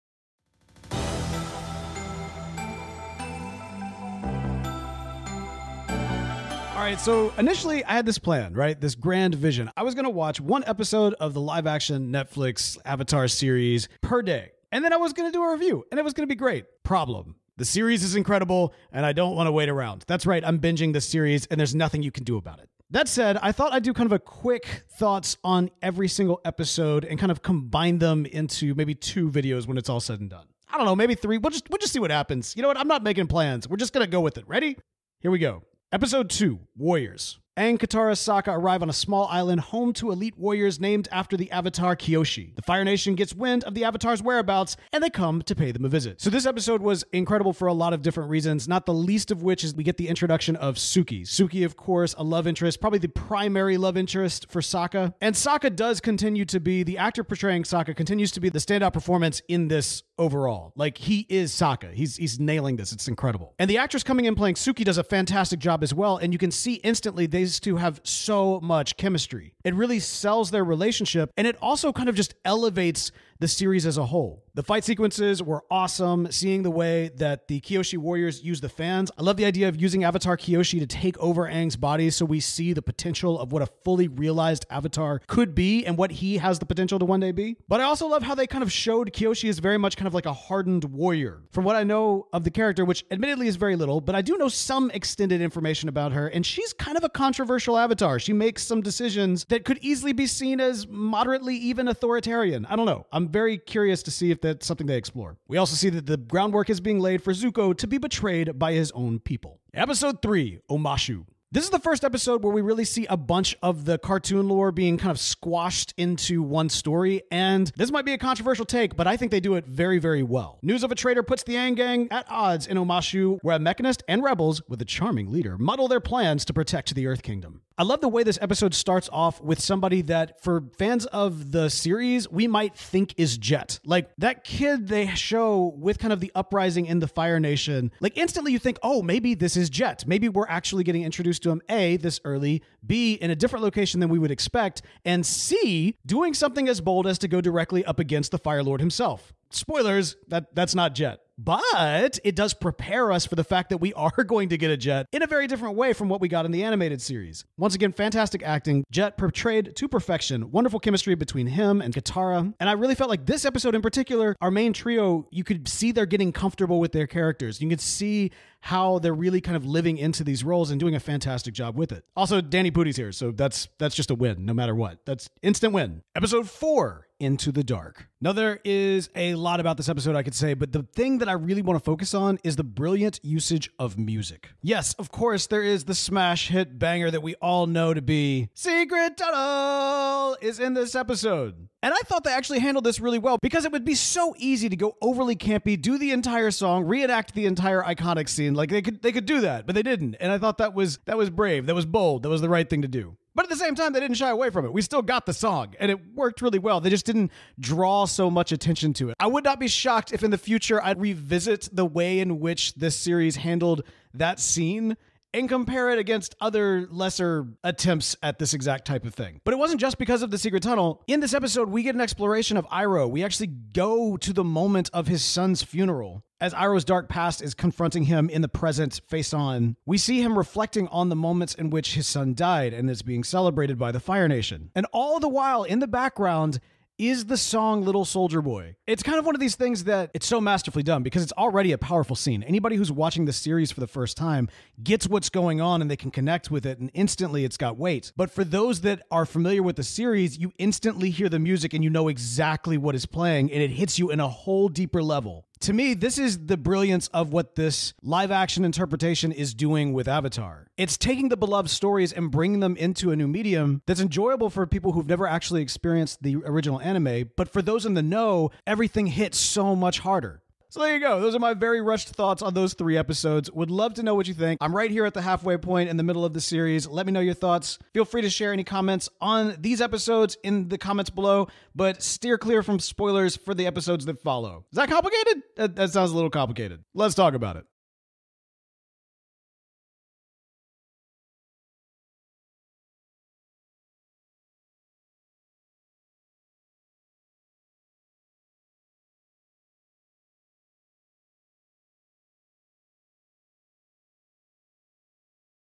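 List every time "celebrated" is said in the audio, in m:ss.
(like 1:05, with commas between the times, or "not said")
3:53.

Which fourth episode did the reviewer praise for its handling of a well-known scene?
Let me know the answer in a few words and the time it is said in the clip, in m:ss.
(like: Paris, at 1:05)
Into the Dark, at 2:57.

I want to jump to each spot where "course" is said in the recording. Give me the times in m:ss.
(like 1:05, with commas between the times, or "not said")
0:51, 3:05.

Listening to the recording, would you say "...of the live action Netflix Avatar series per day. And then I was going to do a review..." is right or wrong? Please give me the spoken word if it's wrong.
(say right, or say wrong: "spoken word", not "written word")
right.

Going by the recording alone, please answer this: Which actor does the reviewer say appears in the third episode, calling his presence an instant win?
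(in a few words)
Danny Pudi.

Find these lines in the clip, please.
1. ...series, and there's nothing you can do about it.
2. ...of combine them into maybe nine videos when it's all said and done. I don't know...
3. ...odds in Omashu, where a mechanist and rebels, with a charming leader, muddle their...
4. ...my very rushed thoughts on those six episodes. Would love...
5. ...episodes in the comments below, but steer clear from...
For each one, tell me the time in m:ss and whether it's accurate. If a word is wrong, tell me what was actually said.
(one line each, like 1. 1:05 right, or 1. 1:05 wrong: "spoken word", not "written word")
1. 0:21 right
2. 0:27 wrong: "two", not "nine"
3. 2:02 right
4. 4:31 wrong: "three", not "six"
5. 4:39 right.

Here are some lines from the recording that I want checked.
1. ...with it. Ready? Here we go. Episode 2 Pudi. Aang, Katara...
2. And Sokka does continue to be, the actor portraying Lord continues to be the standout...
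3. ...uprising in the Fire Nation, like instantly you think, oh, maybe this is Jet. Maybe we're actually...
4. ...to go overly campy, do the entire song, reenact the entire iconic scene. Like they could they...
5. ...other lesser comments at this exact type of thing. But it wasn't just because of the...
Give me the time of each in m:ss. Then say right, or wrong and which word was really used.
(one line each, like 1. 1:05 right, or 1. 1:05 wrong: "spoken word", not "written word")
1. 0:34 wrong: "Warriors", not "Pudi"
2. 0:55 wrong: "Sokka", not "Lord"
3. 2:16 right
4. 3:14 right
5. 3:36 wrong: "attempts", not "comments".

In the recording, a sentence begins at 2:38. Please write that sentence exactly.
Jet portrayed to perfection, wonderful chemistry between him and Katara.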